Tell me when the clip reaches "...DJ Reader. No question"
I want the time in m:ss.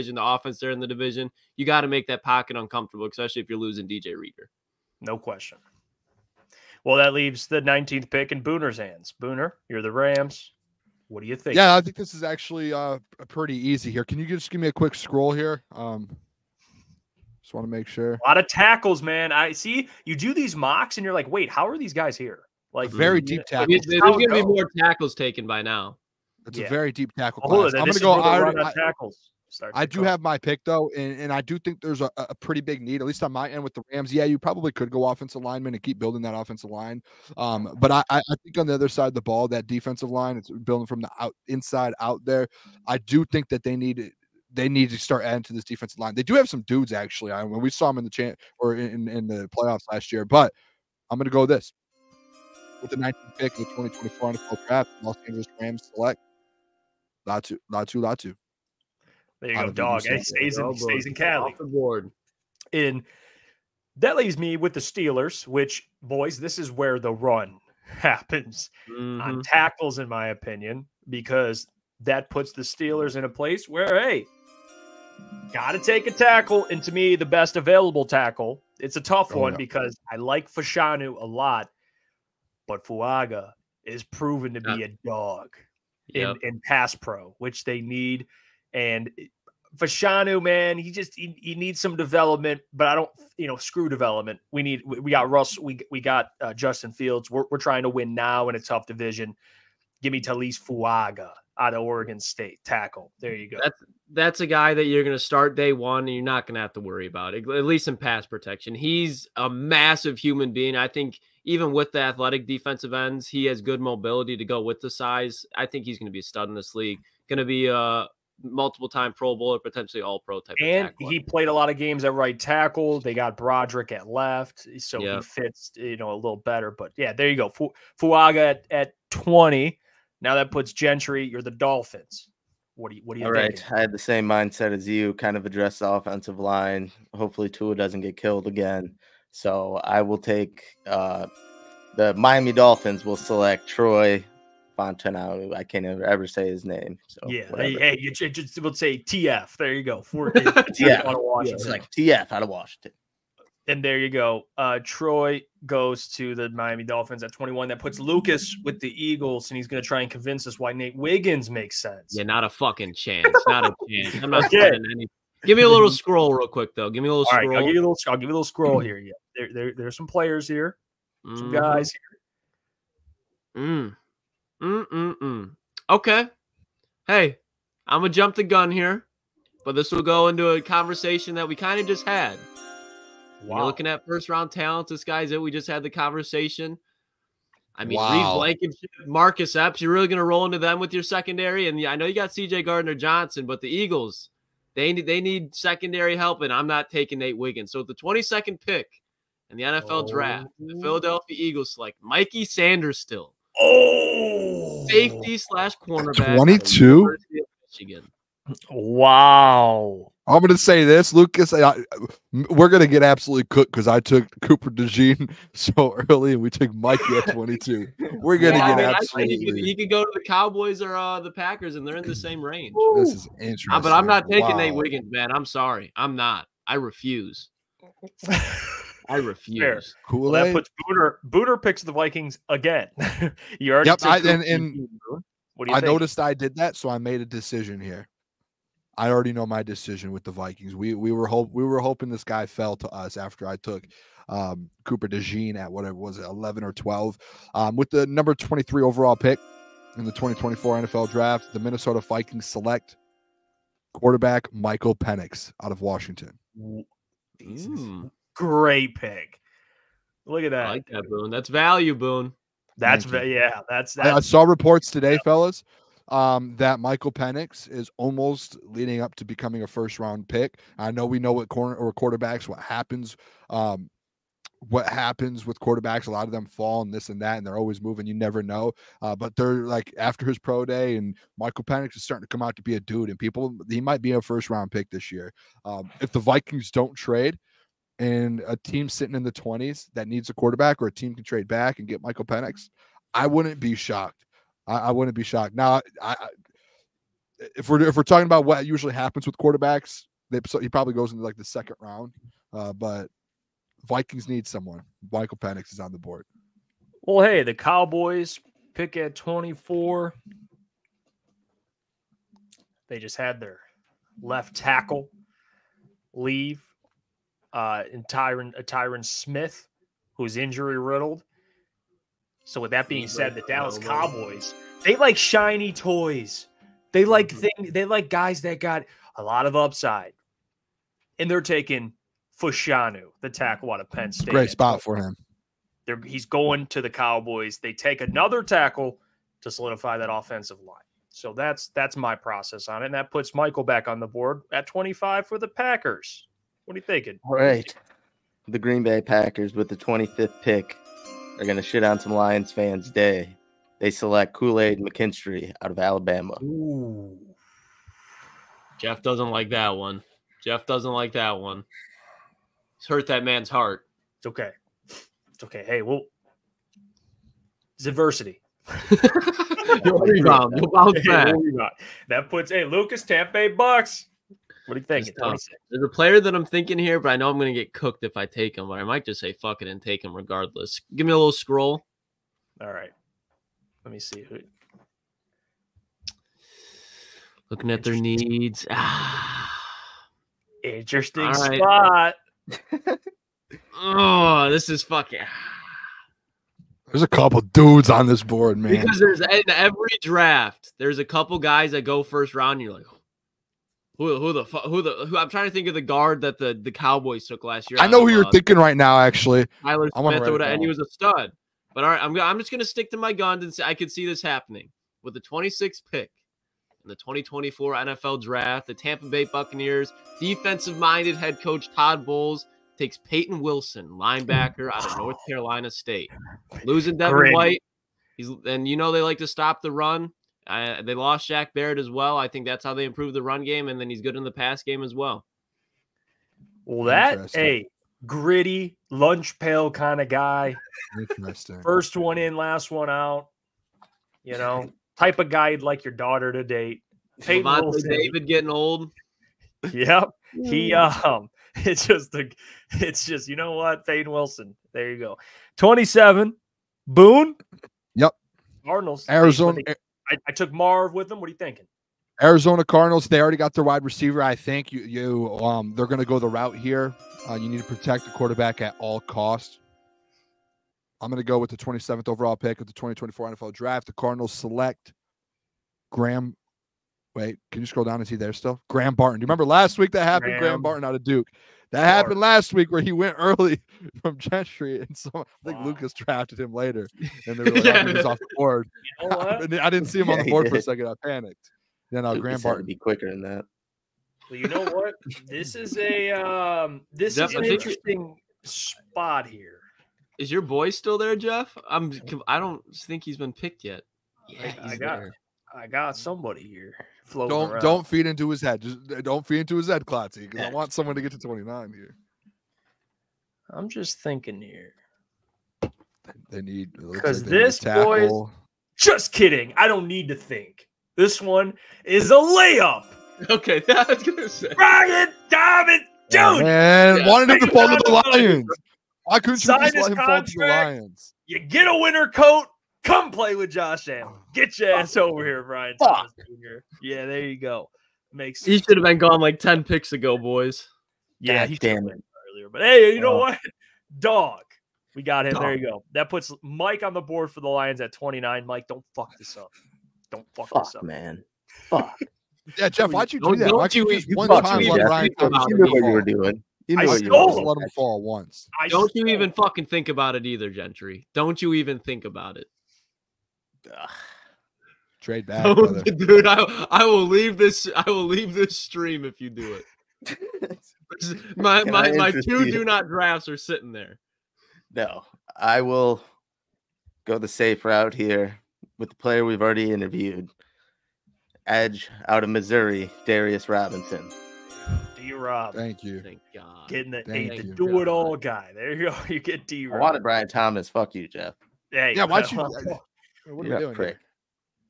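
0:03.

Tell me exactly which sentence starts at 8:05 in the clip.
Lukas drafted him later, and they were like, yeah.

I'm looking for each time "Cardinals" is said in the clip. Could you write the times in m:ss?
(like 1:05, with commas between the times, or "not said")
7:38, 7:42, 7:53.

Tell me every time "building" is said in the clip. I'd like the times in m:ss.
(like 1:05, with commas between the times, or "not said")
0:35, 0:40.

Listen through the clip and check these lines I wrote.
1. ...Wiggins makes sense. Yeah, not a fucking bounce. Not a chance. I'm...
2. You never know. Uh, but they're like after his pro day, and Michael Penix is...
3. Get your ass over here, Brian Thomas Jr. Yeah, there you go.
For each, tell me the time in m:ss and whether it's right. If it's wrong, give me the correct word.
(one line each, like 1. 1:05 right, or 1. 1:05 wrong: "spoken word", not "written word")
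1. 2:40 wrong: "chance", not "bounce"
2. 4:38 right
3. 8:54 right.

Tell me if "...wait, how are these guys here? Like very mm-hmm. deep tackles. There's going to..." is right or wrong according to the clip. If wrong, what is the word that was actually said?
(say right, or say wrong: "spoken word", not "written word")
right.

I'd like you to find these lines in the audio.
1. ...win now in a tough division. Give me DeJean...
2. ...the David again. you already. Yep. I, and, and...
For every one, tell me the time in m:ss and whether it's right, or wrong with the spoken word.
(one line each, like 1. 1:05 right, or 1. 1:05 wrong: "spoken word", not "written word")
1. 1:37 wrong: "Taliese", not "DeJean"
2. 3:51 wrong: "Vikings", not "David".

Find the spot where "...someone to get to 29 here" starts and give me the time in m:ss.
8:30.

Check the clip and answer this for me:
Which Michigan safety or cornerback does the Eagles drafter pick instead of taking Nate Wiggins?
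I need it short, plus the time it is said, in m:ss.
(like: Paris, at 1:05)
Mikey Sainristil, at 3:22.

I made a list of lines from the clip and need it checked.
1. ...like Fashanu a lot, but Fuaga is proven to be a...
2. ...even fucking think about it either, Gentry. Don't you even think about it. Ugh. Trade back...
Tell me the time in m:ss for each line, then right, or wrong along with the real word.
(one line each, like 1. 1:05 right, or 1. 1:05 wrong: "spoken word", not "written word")
1. 1:20 right
2. 9:19 right.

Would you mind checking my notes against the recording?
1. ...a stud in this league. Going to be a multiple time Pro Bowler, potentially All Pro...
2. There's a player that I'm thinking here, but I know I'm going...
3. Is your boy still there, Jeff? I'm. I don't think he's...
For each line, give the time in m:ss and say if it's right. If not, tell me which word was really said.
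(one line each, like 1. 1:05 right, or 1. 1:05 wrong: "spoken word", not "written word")
1. 1:56 right
2. 6:15 right
3. 8:20 right.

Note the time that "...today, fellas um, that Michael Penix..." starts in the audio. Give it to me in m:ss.
4:24.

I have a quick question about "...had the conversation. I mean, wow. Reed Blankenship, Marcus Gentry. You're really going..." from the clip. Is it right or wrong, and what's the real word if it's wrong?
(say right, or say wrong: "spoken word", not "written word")
wrong: "Epps", not "Gentry".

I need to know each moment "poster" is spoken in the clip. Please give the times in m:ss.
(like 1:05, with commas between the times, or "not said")
not said.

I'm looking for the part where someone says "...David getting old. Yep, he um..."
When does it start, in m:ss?
7:27.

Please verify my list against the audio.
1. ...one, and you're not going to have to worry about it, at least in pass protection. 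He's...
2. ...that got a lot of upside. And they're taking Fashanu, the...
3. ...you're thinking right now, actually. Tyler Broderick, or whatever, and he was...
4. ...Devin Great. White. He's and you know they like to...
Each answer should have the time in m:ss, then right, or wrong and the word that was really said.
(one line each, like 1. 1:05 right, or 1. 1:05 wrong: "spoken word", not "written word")
1. 1:45 right
2. 5:28 right
3. 6:48 wrong: "Smith", not "Broderick"
4. 7:06 right.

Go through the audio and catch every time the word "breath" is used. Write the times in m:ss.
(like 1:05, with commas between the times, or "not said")
not said.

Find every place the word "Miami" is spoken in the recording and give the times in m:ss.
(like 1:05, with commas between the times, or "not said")
2:22, 2:36.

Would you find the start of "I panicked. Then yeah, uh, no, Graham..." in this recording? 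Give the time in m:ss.
8:10.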